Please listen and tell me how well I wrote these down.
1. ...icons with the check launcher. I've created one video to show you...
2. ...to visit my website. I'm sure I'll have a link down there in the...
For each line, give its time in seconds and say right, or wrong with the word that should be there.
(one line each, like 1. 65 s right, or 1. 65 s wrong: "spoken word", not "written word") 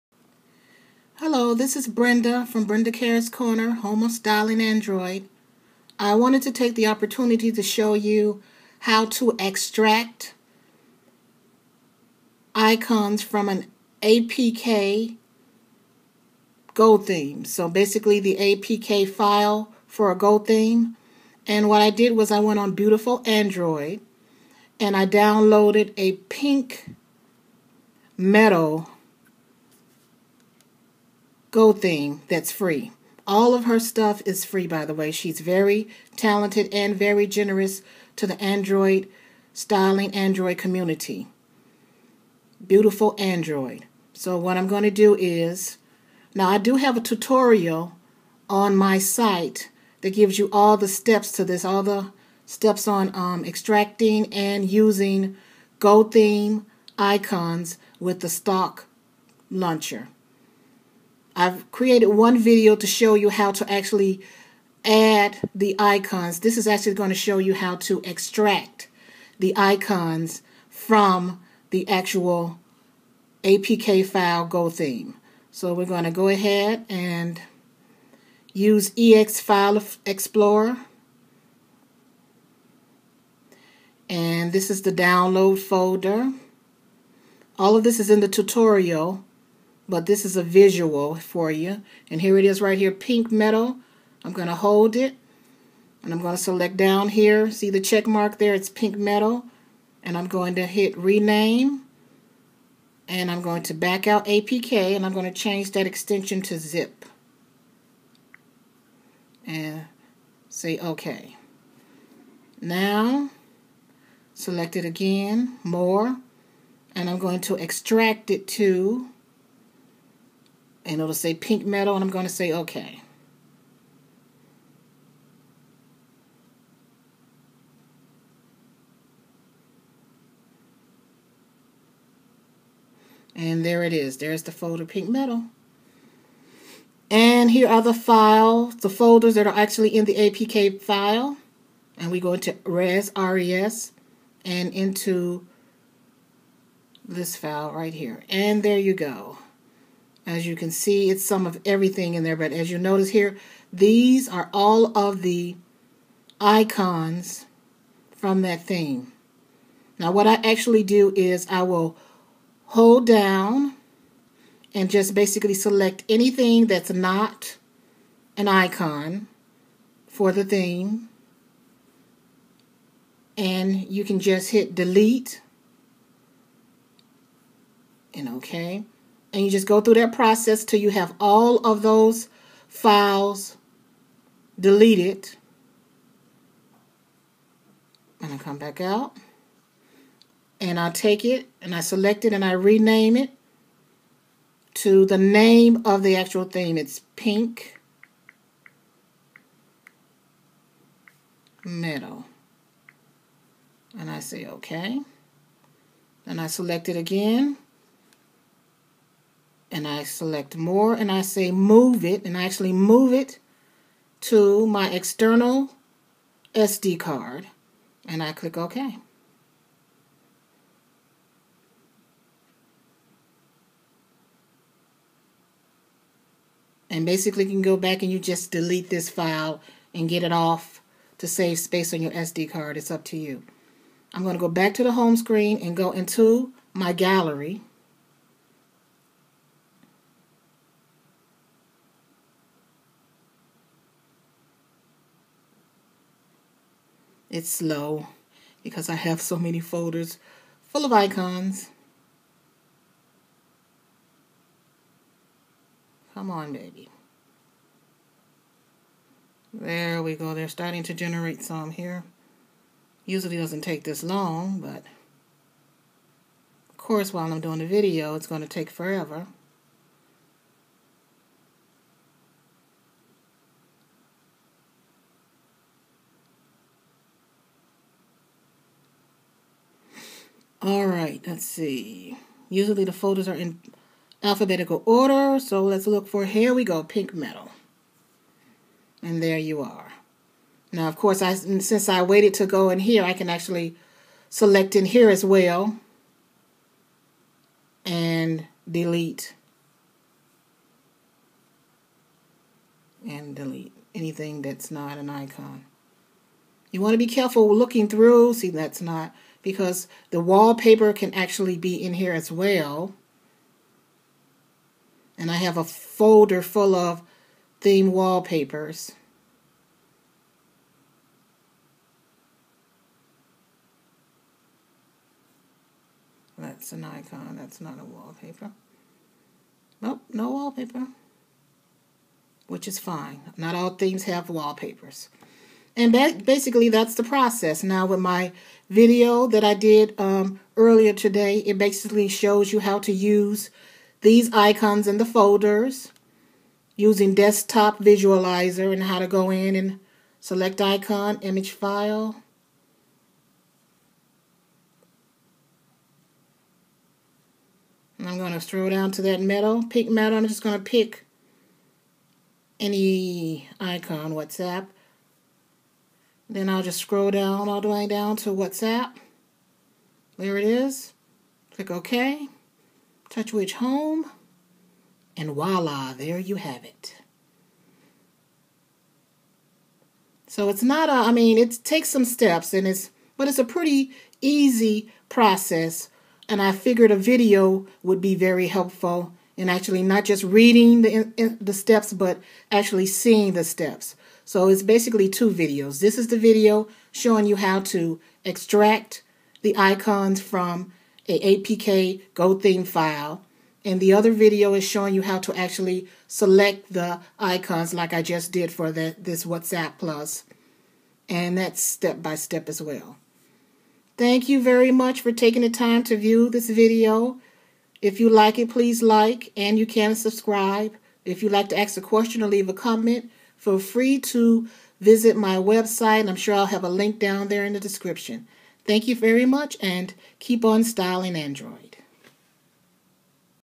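1. 56 s wrong: "stock", not "check"
2. 423 s right.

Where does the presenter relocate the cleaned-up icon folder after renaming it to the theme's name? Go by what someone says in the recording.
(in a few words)
external SD card.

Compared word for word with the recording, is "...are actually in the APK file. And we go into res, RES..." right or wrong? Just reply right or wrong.
right.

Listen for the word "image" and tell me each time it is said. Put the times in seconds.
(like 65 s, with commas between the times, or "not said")
351 s.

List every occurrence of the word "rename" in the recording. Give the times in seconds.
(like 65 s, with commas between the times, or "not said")
100 s, 192 s.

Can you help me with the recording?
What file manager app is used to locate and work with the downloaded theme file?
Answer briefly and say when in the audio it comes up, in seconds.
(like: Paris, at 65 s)
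ES File Explorer, at 78 s.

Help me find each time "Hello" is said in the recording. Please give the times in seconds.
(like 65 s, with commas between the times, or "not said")
1 s.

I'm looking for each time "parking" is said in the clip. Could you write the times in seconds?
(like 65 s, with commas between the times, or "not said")
not said.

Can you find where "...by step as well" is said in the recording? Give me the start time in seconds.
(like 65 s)
412 s.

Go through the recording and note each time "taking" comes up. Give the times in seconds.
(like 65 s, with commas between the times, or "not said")
415 s.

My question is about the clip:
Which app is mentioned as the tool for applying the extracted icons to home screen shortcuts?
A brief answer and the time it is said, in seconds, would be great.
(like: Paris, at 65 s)
desktop visualizer, at 347 s.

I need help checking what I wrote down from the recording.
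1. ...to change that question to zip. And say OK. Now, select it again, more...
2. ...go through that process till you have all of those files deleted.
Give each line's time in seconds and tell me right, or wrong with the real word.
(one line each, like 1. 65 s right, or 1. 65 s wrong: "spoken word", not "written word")
1. 105 s wrong: "extension", not "question"
2. 179 s right.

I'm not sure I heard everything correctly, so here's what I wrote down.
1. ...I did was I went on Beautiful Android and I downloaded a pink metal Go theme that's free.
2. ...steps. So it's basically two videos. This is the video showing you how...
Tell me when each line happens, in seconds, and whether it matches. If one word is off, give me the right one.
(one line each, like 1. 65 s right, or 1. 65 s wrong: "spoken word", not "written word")
1. 21 s right
2. 393 s right.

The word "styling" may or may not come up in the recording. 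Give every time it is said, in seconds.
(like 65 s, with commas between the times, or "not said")
4 s, 39 s, 430 s.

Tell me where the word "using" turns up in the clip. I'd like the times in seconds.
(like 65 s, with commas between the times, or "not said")
54 s, 346 s.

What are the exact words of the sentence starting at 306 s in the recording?
You want to be careful looking through.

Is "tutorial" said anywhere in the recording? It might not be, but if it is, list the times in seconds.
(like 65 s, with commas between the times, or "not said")
47 s, 88 s.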